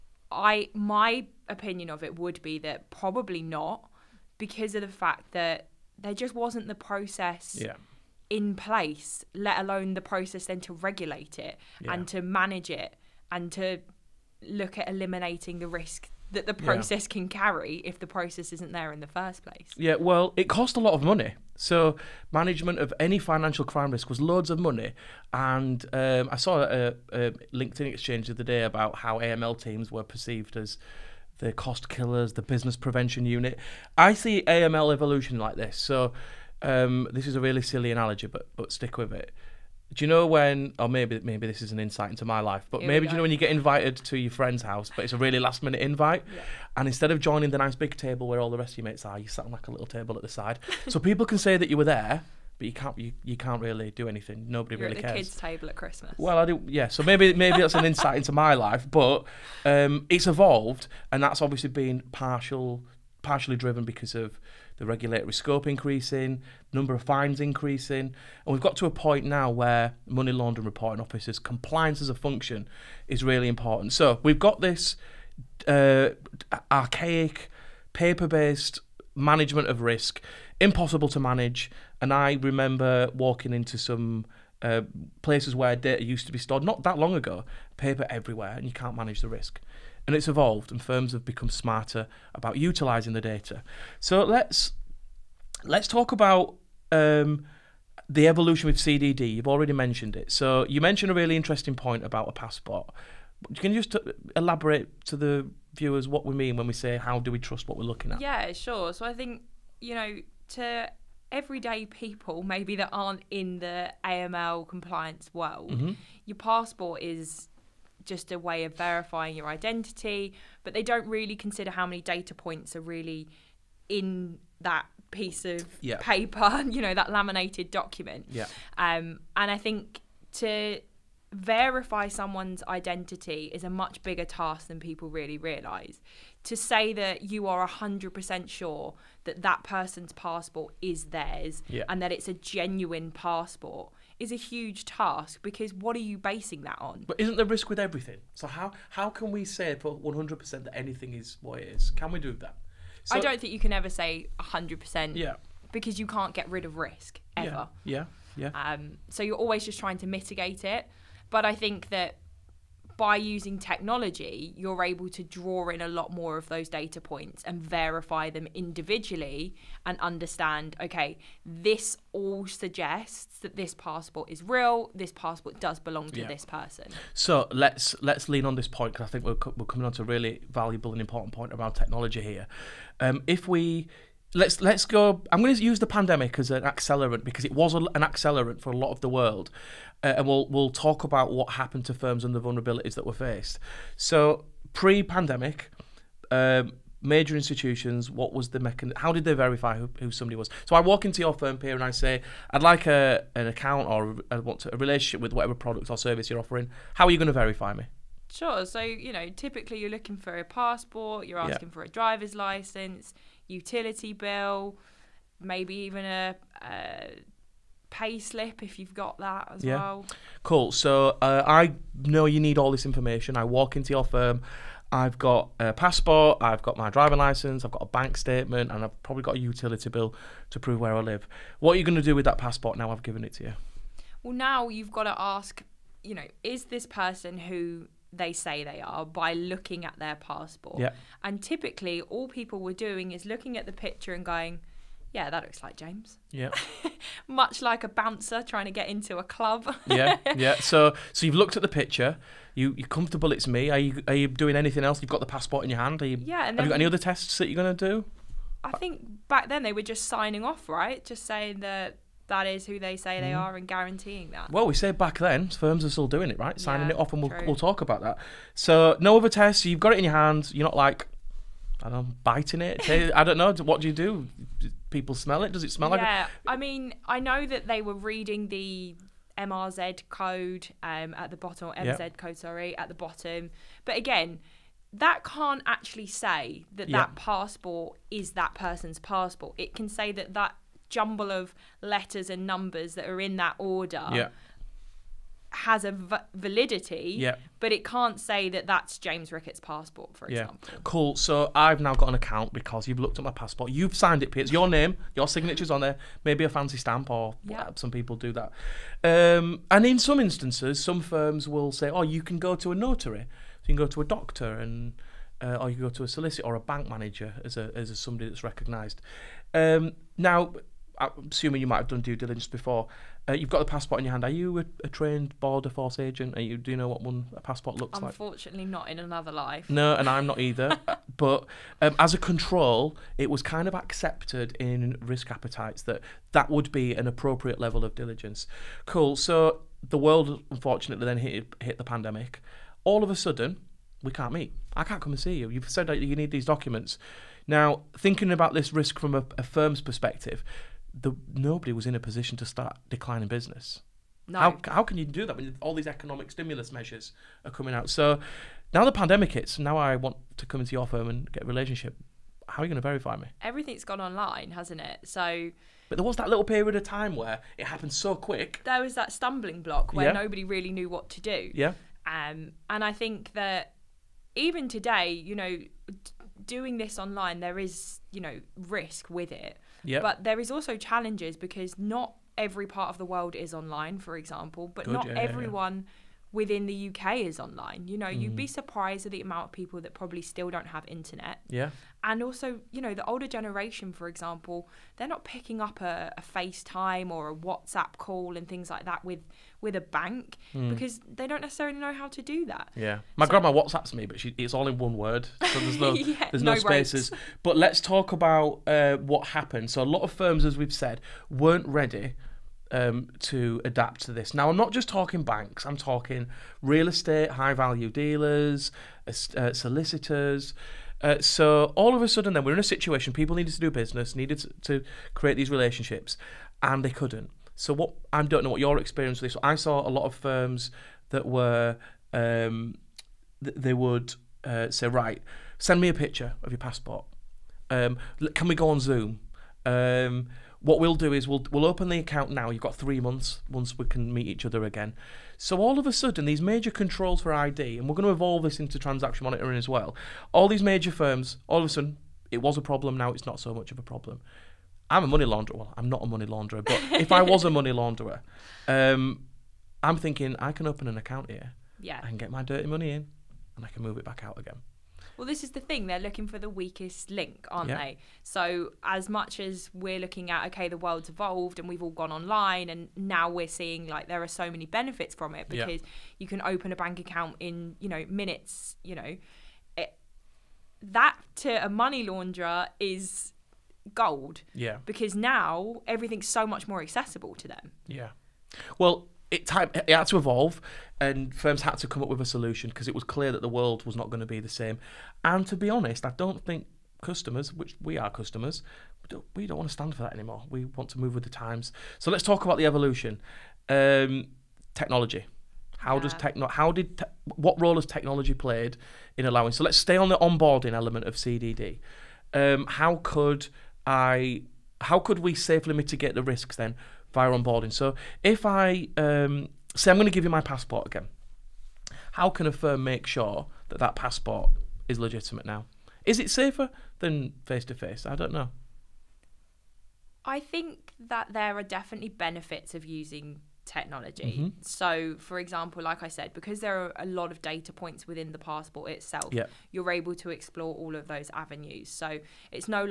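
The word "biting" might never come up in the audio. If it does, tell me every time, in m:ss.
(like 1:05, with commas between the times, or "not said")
4:32.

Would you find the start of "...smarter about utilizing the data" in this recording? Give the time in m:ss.
1:31.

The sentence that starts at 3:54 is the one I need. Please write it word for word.
Well, now you've got to ask, you know, is this person who they say they are by looking at their passport.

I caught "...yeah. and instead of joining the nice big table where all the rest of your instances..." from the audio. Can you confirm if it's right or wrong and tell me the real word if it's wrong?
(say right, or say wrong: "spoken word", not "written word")
wrong: "mates", not "instances".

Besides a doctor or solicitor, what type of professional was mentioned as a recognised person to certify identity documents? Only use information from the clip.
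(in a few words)
A bank manager.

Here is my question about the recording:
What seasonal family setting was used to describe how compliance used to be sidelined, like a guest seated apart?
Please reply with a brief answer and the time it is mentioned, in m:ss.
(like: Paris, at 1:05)
Kids table at Christmas, at 0:55.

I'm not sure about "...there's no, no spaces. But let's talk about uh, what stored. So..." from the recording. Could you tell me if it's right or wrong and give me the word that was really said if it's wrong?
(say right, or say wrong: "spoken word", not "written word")
wrong: "happened", not "stored".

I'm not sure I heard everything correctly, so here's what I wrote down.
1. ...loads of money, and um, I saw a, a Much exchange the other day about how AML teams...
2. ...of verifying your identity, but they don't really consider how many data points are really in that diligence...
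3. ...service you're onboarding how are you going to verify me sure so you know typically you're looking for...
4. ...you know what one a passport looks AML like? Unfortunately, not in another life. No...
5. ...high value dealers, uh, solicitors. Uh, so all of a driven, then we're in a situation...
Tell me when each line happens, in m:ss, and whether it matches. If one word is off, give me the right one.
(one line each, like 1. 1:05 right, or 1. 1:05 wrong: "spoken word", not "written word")
1. 0:24 wrong: "LinkedIn", not "Much"
2. 1:58 wrong: "piece", not "diligence"
3. 3:25 wrong: "offering", not "onboarding"
4. 5:26 wrong: "Unfortunately", not "AML"
5. 6:57 wrong: "sudden", not "driven".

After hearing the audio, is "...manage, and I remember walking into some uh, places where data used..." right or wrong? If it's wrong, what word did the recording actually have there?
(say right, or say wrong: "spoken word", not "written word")
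right.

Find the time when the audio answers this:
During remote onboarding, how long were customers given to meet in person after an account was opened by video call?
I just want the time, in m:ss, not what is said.
7:22.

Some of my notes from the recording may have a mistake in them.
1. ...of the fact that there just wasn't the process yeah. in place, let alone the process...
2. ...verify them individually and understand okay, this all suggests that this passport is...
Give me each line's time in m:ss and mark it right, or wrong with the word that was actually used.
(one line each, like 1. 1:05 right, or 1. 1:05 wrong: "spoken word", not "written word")
1. 0:04 right
2. 2:47 right.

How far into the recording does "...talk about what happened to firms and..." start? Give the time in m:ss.
3:10.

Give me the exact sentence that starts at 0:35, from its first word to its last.
So um, this is a really silly analogy, but but stick with it.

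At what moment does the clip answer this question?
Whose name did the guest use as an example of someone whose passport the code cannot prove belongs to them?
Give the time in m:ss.
4:58.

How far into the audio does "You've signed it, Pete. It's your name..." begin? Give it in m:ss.
5:03.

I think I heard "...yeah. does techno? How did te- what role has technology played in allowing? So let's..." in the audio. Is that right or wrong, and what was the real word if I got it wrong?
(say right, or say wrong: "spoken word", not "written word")
right.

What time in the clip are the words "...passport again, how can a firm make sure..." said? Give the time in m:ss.
8:40.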